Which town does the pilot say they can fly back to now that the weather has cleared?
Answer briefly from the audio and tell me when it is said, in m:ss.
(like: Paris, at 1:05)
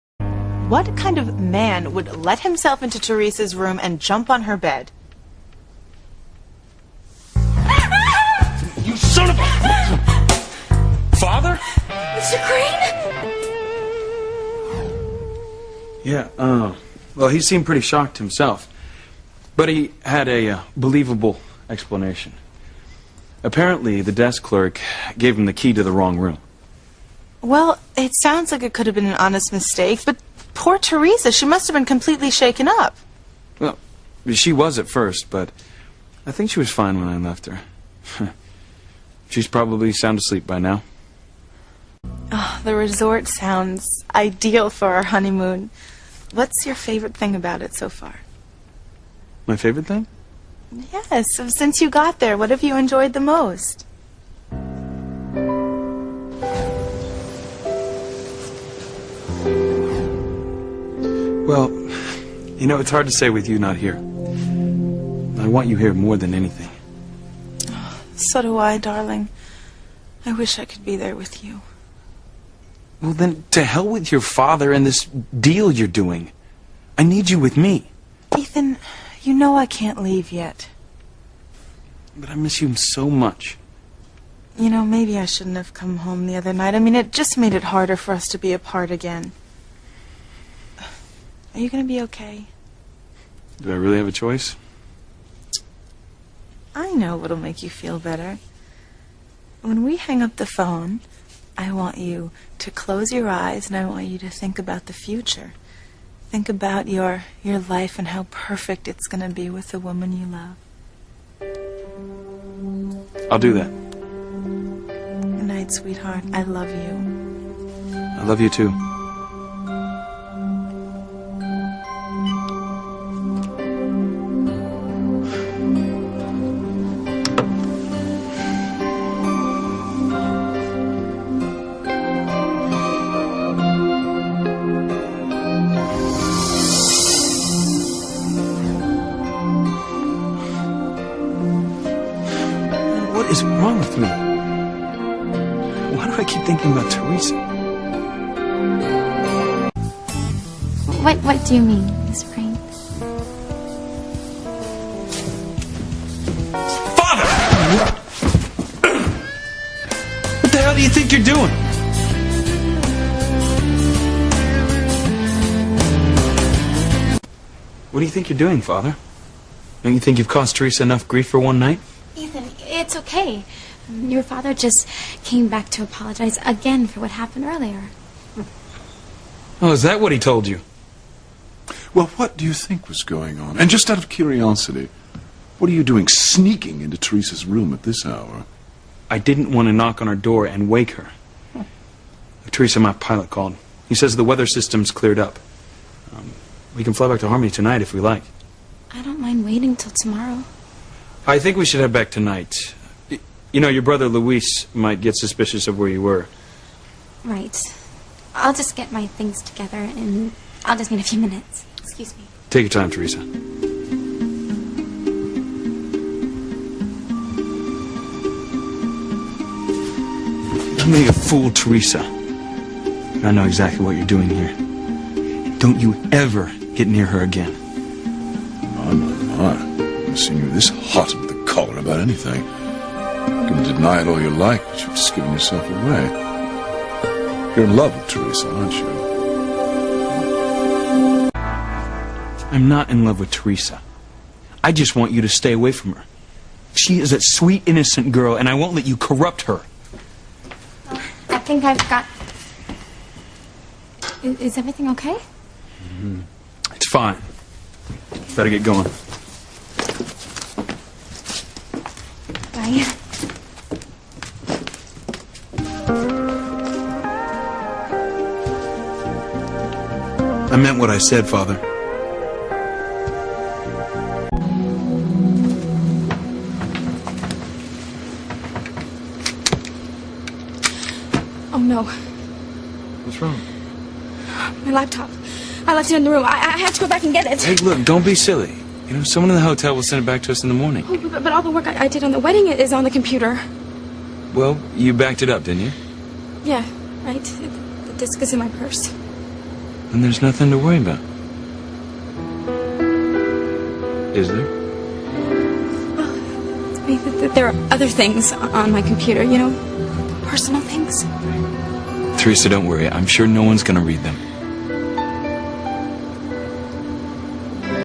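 Harmony, at 3:17.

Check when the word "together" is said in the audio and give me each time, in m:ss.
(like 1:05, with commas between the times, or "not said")
3:29.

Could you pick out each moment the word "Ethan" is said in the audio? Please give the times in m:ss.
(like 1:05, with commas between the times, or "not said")
1:18, 2:52.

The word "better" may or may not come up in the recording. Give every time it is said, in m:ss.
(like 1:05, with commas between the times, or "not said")
1:37, 4:18.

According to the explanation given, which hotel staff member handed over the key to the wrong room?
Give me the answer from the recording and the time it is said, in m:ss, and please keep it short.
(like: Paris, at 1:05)
Desk clerk, at 0:24.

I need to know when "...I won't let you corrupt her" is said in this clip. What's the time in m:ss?
4:08.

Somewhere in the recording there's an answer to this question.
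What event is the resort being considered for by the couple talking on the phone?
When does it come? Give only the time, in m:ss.
0:45.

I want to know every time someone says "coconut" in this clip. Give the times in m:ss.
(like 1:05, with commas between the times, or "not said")
not said.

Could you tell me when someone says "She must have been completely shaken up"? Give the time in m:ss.
0:31.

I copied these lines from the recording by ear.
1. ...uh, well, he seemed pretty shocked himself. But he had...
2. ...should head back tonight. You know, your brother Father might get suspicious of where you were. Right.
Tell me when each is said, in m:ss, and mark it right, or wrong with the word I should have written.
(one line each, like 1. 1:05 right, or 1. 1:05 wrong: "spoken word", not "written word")
1. 0:16 right
2. 3:21 wrong: "Luis", not "Father".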